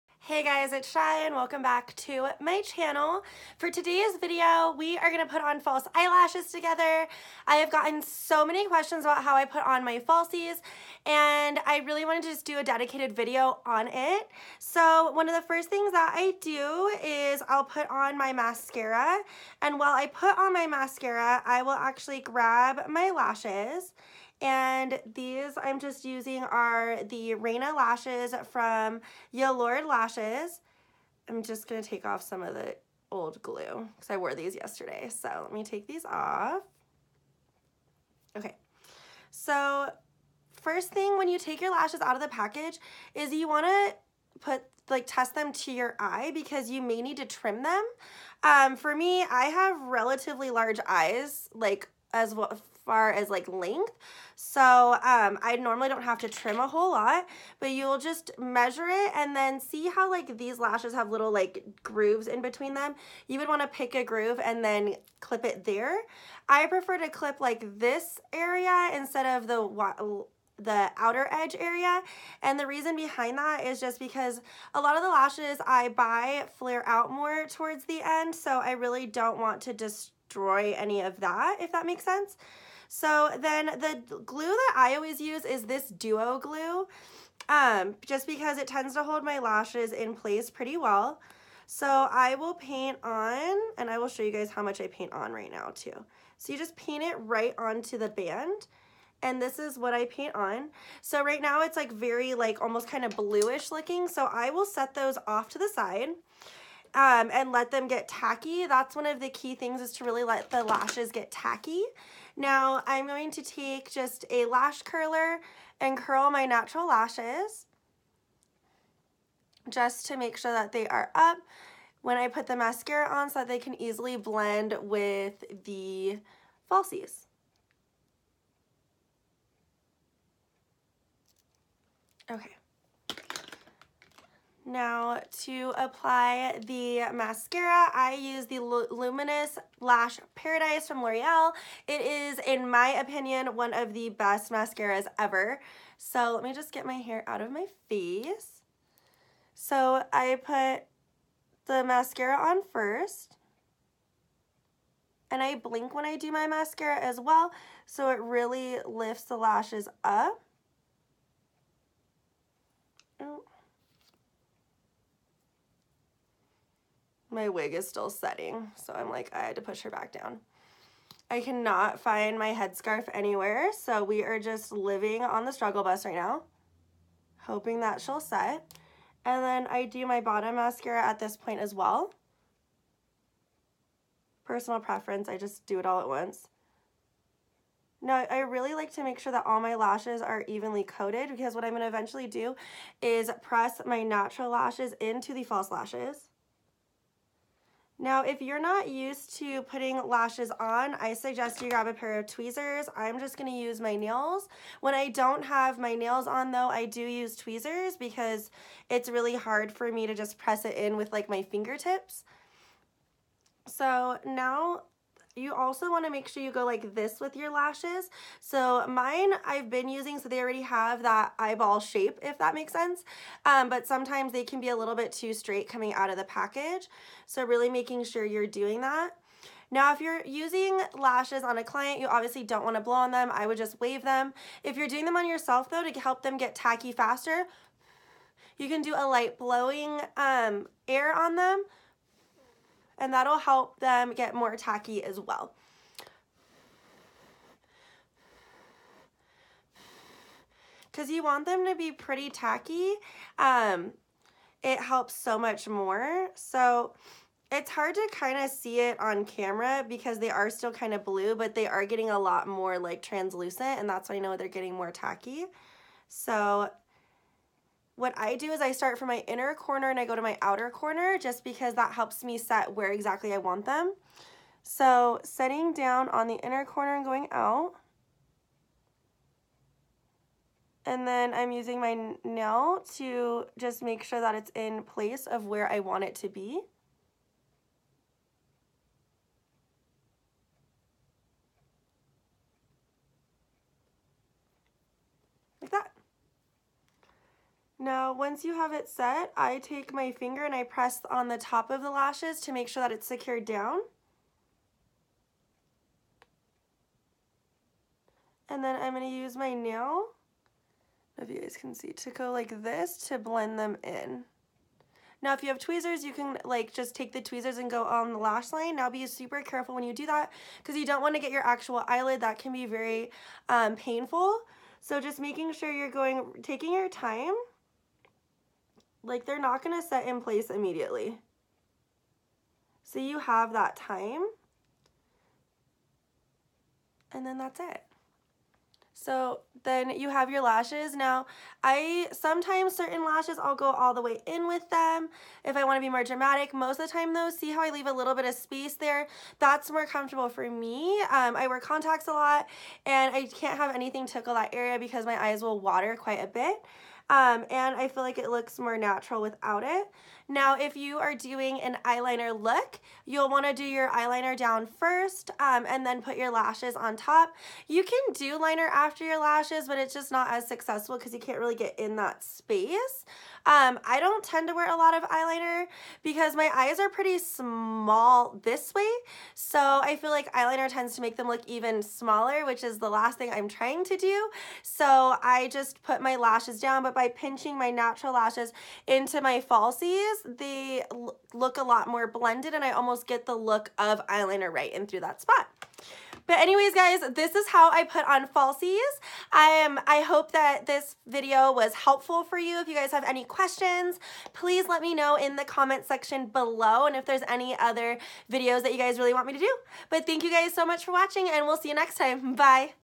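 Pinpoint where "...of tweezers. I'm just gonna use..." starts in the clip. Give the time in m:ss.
3:22.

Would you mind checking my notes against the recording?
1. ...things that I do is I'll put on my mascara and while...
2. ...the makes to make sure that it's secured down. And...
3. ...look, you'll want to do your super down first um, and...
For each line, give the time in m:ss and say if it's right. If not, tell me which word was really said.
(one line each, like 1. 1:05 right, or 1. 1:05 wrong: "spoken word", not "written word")
1. 0:15 right
2. 5:01 wrong: "lashes", not "makes"
3. 6:02 wrong: "eyeliner", not "super".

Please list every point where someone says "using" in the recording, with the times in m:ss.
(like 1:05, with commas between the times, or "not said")
0:26, 3:39, 3:50, 4:41.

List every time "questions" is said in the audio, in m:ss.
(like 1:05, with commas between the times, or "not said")
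0:08, 6:43.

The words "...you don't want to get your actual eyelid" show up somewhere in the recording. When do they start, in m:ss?
5:20.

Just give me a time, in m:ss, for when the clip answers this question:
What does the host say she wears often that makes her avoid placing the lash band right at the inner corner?
5:51.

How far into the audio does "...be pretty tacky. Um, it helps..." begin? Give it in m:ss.
4:11.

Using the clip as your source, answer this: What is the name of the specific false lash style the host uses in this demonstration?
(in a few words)
Reina.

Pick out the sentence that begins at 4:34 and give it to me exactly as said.
So setting down on the inner corner and going out.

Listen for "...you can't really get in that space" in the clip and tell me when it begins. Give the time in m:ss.
6:11.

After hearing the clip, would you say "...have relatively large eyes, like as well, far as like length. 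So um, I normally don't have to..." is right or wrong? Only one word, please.
right.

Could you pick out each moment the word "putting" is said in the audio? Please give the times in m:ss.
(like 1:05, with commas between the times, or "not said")
3:19.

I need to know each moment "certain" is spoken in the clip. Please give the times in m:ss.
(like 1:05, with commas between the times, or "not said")
5:42.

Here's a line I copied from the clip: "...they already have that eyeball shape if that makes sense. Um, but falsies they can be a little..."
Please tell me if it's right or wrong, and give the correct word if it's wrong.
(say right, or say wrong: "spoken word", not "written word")
wrong: "sometimes", not "falsies".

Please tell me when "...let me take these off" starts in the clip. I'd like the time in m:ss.
0:35.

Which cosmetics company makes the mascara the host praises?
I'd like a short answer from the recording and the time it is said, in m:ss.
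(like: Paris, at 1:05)
L'Oreal, at 2:21.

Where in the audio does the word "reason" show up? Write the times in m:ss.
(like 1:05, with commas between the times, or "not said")
1:12.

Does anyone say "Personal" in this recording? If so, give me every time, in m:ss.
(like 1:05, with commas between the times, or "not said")
3:04.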